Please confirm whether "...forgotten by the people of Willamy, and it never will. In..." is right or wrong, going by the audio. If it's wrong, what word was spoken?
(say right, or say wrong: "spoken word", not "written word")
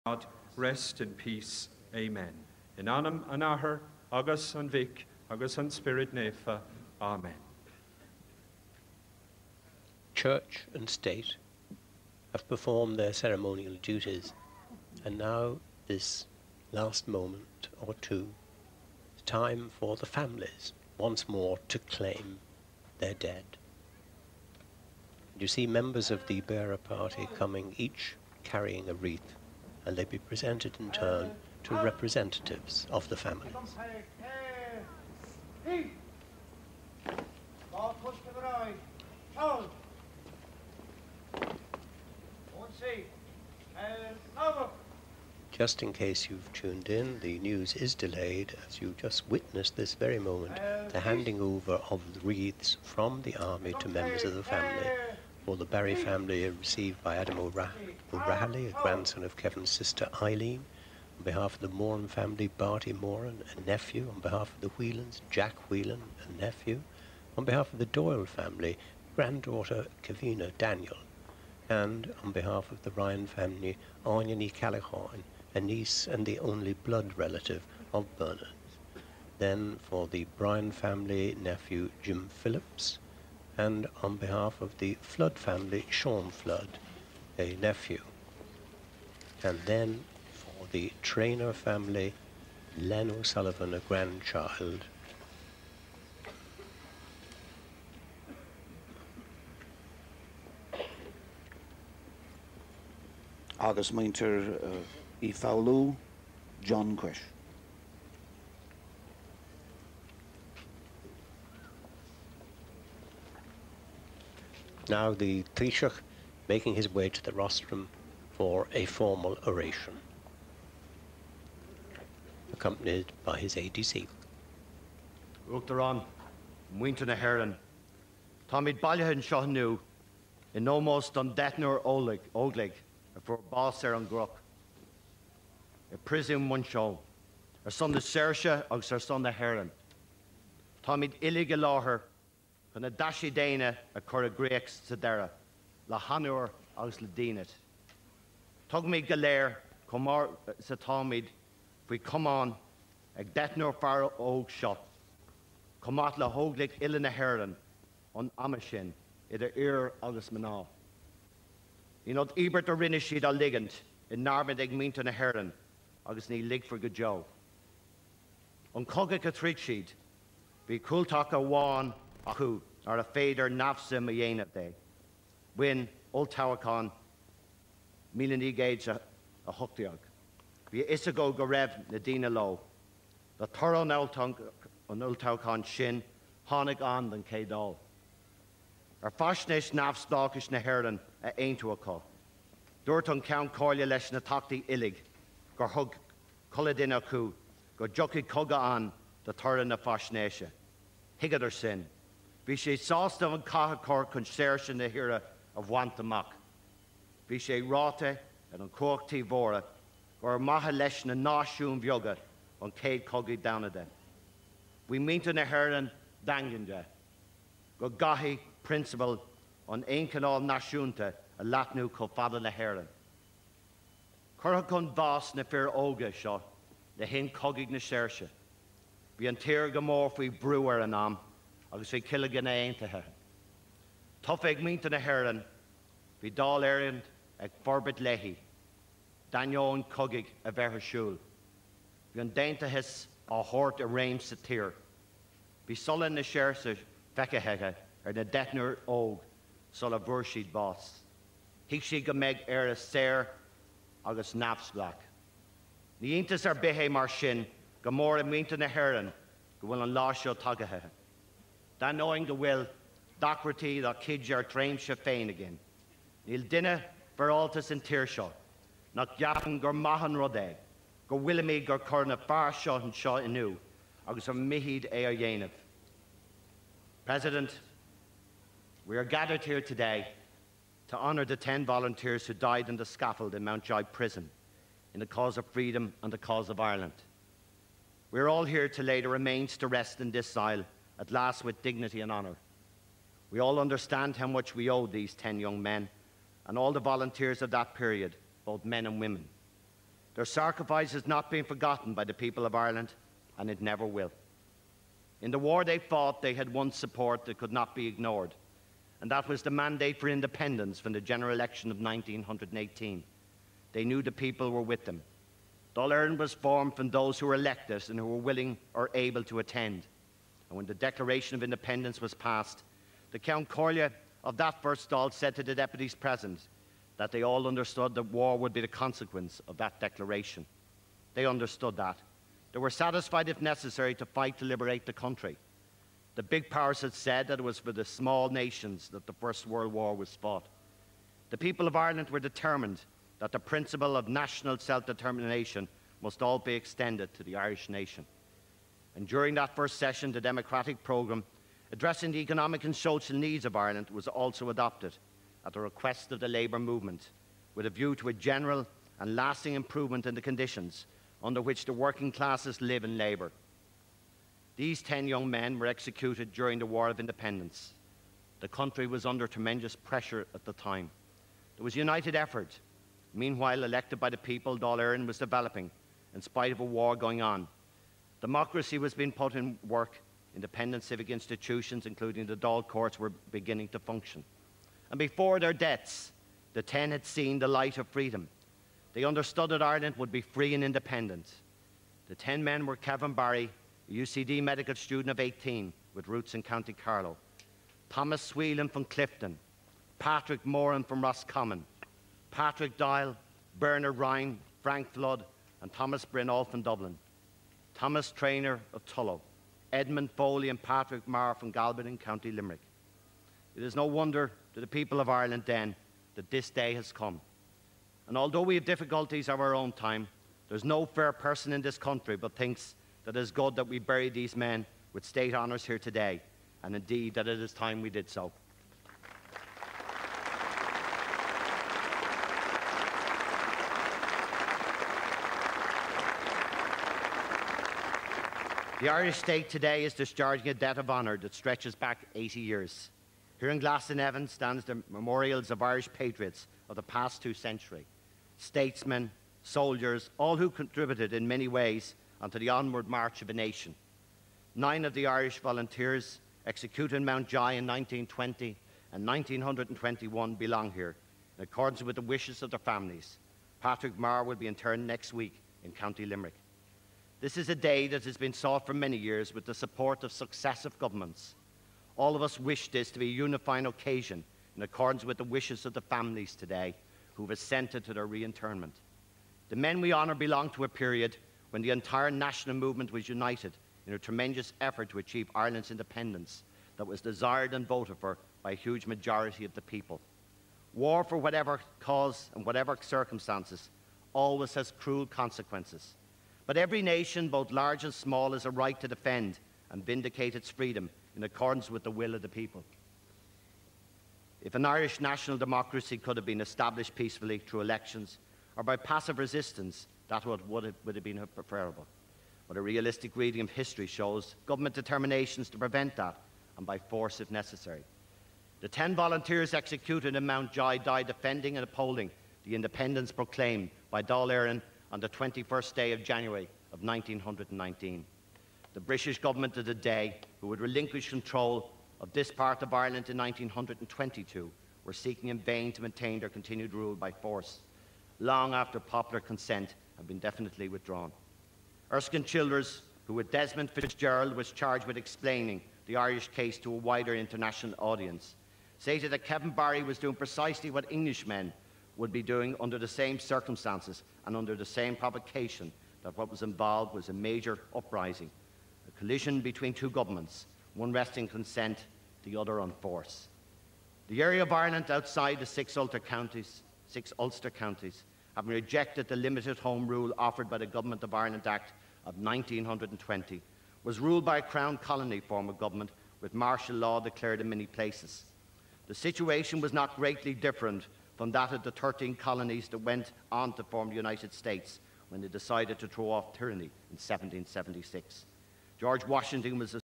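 wrong: "Ireland", not "Willamy".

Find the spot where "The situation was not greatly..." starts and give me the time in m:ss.
9:38.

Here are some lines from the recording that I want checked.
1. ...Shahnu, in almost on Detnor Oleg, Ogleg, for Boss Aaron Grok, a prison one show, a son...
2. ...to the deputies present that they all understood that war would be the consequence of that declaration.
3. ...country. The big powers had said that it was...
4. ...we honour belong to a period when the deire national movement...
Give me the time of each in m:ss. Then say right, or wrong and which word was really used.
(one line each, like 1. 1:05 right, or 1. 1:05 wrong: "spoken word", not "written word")
1. 2:09 right
2. 5:25 right
3. 5:34 right
4. 7:59 wrong: "entire", not "deire".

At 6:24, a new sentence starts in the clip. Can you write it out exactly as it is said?
And before their deaths, the ten had seen the light of freedom.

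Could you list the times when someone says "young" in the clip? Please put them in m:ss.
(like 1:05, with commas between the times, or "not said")
4:55, 6:05.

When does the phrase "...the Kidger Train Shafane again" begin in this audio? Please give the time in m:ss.
4:23.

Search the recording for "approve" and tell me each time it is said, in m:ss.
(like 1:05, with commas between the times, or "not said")
not said.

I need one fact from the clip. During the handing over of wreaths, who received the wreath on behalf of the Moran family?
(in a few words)
Barty Moran.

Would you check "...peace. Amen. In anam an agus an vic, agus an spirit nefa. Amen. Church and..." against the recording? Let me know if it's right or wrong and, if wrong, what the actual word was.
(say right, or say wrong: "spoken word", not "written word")
right.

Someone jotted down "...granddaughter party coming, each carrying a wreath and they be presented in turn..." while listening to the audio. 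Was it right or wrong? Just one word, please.
wrong.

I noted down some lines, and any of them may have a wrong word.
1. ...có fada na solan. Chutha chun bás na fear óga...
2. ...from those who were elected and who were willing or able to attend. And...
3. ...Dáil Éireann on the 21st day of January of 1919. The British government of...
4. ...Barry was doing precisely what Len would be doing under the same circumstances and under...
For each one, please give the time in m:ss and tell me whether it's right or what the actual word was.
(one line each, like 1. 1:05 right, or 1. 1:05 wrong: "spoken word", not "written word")
1. 3:41 wrong: "hhéan", not "solan"
2. 5:16 right
3. 8:44 right
4. 9:09 wrong: "Englishmen", not "Len".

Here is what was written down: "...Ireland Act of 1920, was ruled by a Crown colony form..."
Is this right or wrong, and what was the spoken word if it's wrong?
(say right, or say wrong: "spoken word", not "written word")
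right.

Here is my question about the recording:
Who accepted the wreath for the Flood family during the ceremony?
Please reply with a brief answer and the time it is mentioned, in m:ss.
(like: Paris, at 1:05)
Sean Flood, at 1:25.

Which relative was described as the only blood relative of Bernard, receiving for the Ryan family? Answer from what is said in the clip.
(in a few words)
Anya Callaghan.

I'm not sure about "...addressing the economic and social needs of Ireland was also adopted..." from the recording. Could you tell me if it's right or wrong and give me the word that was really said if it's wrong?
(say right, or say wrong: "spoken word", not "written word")
right.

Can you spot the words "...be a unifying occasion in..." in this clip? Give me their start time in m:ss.
7:52.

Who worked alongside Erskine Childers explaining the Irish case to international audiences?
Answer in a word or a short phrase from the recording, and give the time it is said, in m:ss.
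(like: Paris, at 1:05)
Desmond Fitzgerald, at 9:03.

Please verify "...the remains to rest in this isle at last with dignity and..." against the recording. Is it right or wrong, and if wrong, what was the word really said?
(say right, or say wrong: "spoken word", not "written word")
right.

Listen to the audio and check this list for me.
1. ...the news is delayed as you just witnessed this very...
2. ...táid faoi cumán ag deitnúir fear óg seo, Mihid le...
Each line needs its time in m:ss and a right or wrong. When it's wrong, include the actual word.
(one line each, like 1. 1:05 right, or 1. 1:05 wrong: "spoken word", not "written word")
1. 0:47 right
2. 2:30 wrong: "Comát", not "Mihid".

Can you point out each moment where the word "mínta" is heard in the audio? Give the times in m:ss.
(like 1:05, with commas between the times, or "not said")
2:44, 3:35, 3:54, 4:18.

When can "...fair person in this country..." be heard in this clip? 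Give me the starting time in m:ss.
7:00.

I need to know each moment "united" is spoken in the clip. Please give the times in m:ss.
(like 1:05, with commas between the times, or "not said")
6:11, 8:03, 9:43.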